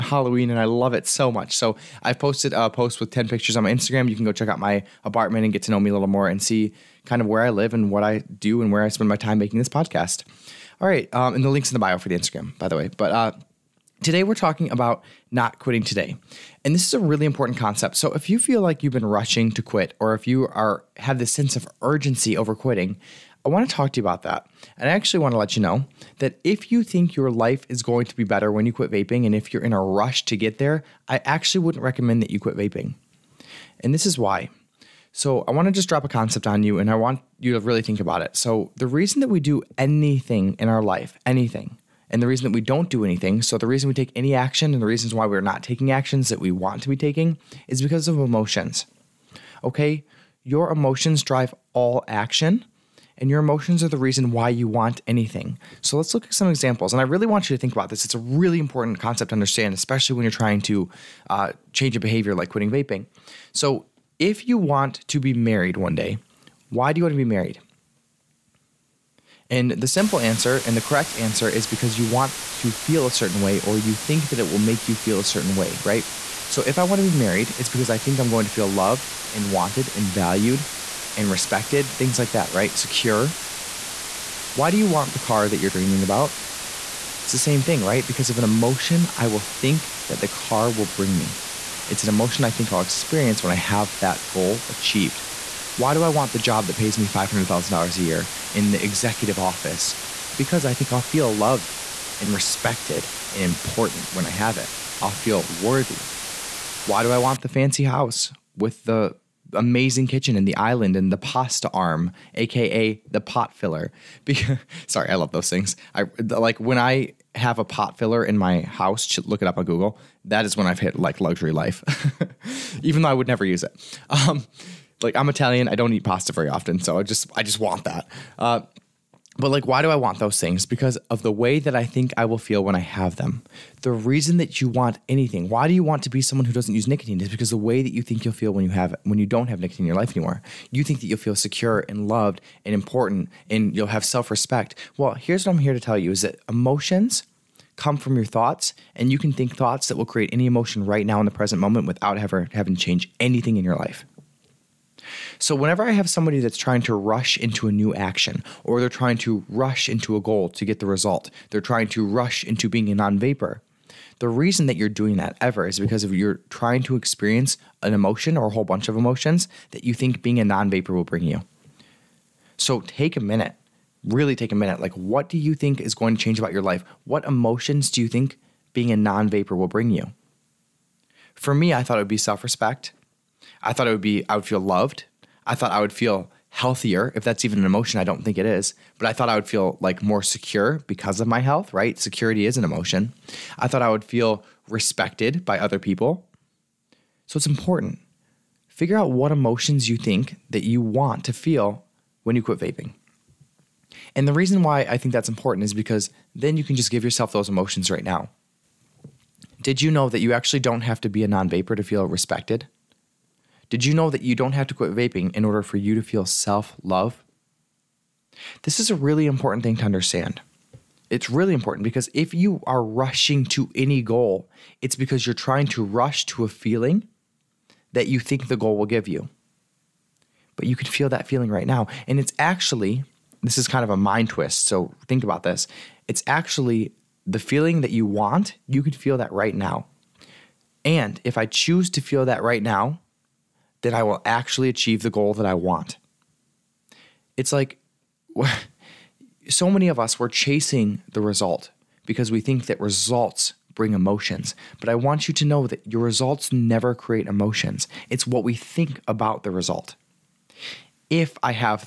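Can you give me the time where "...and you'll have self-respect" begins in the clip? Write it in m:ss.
2:23.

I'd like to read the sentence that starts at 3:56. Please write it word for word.
It's actually the feeling that you want, you can feel that right now.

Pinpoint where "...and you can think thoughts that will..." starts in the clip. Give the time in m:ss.
2:28.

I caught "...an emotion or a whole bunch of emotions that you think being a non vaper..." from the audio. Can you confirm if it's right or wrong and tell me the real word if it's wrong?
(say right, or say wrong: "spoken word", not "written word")
right.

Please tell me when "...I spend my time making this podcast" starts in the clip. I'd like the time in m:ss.
0:08.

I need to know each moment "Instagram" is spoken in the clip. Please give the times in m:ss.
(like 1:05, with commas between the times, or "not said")
0:03, 0:12.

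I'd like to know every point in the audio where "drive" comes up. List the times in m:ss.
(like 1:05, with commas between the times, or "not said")
0:51.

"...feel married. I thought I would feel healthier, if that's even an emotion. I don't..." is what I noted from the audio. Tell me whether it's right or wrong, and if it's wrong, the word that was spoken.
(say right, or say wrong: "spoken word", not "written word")
wrong: "loved", not "married".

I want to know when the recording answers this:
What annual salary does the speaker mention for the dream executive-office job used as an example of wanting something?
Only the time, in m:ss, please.
1:37.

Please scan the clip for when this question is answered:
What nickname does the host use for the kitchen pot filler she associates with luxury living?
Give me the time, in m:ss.
1:51.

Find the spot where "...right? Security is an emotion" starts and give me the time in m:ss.
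3:11.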